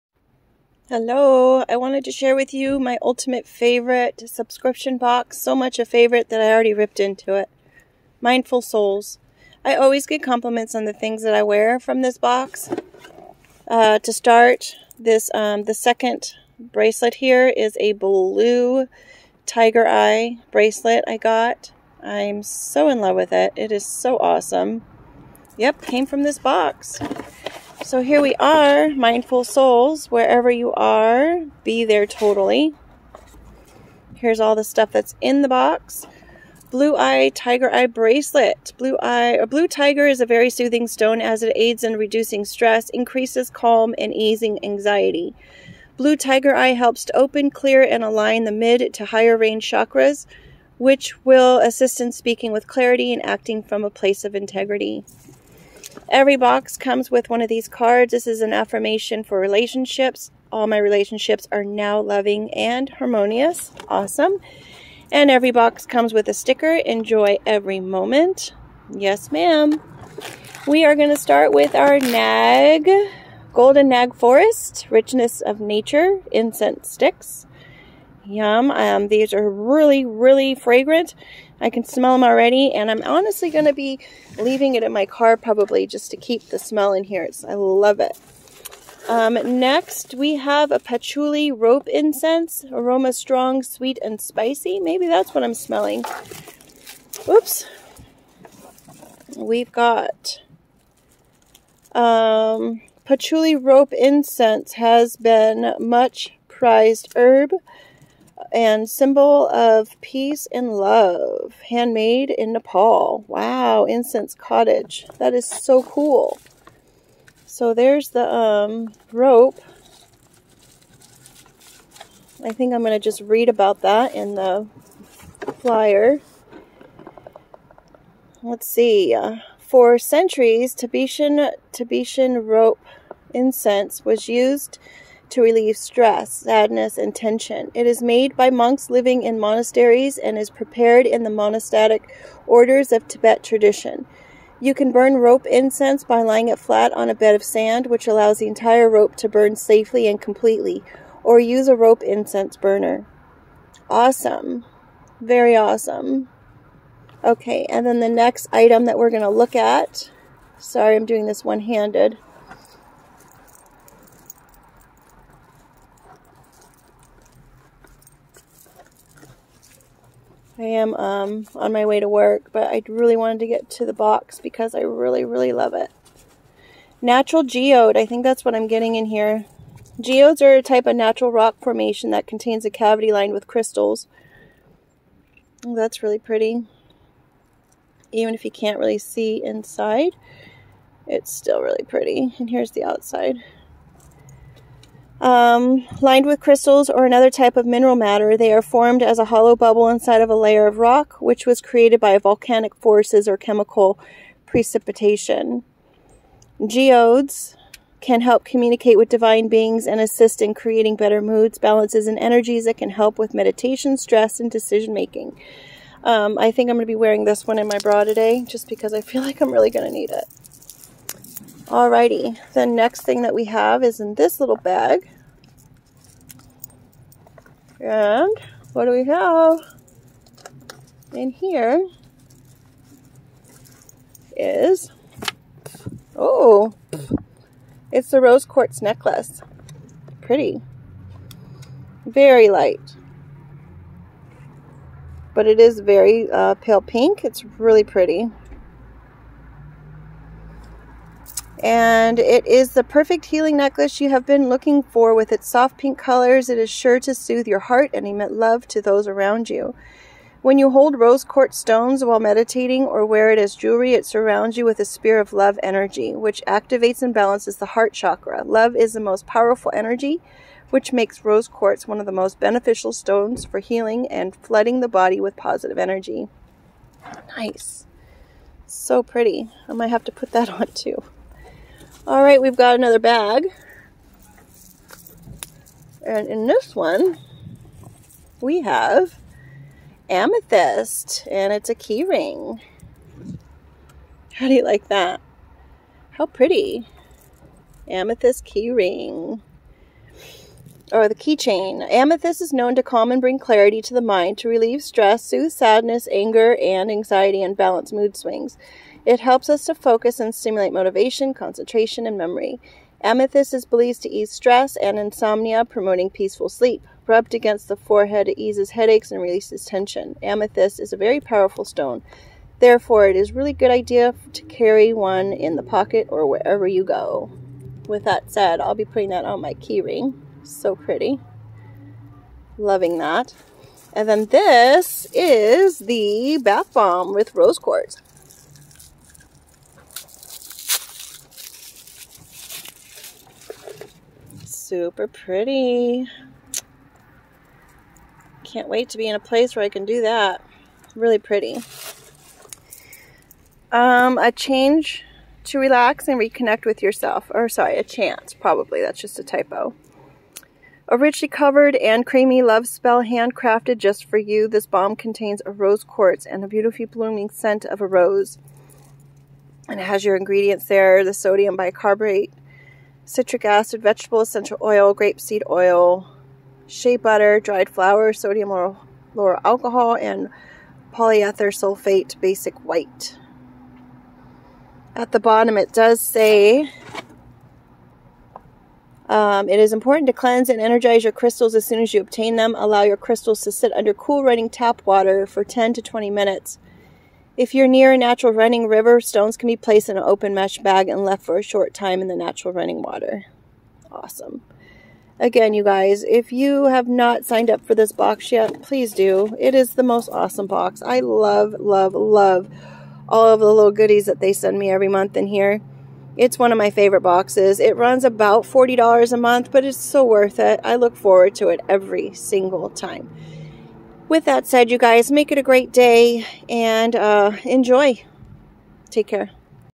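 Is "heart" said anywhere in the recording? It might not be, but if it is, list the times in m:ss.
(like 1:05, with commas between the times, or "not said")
4:17, 4:27.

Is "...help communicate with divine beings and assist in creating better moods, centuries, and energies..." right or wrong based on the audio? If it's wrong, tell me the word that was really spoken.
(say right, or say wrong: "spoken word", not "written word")
wrong: "balances", not "centuries".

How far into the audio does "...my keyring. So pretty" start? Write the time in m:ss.
5:29.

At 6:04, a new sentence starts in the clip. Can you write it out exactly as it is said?
This balm contains a rose quartz and a beautifully blooming scent of a rose.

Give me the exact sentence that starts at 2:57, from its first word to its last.
Natural geode, I think that's what I'm getting in here.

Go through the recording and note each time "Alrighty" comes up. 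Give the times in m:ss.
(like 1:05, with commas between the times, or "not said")
3:41.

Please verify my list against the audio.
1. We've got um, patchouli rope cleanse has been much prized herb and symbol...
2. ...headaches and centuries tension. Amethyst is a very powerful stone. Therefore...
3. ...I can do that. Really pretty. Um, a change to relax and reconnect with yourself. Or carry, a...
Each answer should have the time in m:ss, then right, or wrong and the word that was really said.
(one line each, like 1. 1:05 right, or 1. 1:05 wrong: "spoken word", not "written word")
1. 1:39 wrong: "incense", not "cleanse"
2. 5:18 wrong: "releases", not "centuries"
3. 5:49 wrong: "sorry", not "carry".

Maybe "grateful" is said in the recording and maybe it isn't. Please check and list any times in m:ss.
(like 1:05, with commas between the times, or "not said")
not said.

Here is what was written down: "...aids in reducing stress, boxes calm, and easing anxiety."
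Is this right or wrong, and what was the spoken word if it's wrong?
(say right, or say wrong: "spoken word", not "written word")
wrong: "increases", not "boxes".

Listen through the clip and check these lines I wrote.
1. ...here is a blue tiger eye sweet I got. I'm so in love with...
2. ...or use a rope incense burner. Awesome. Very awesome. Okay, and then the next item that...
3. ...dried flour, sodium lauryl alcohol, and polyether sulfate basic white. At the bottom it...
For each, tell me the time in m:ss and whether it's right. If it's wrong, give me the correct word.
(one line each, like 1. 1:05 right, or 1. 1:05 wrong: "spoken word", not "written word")
1. 0:17 wrong: "bracelet", not "sweet"
2. 2:31 right
3. 6:17 right.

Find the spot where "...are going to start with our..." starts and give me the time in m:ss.
1:10.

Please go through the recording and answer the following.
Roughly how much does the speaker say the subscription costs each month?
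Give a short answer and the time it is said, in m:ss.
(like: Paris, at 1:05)
$40, at 6:58.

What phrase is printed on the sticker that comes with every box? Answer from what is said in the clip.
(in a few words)
Enjoy every moment.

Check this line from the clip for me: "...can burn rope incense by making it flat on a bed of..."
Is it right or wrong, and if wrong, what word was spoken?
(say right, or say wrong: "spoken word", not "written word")
wrong: "laying", not "making".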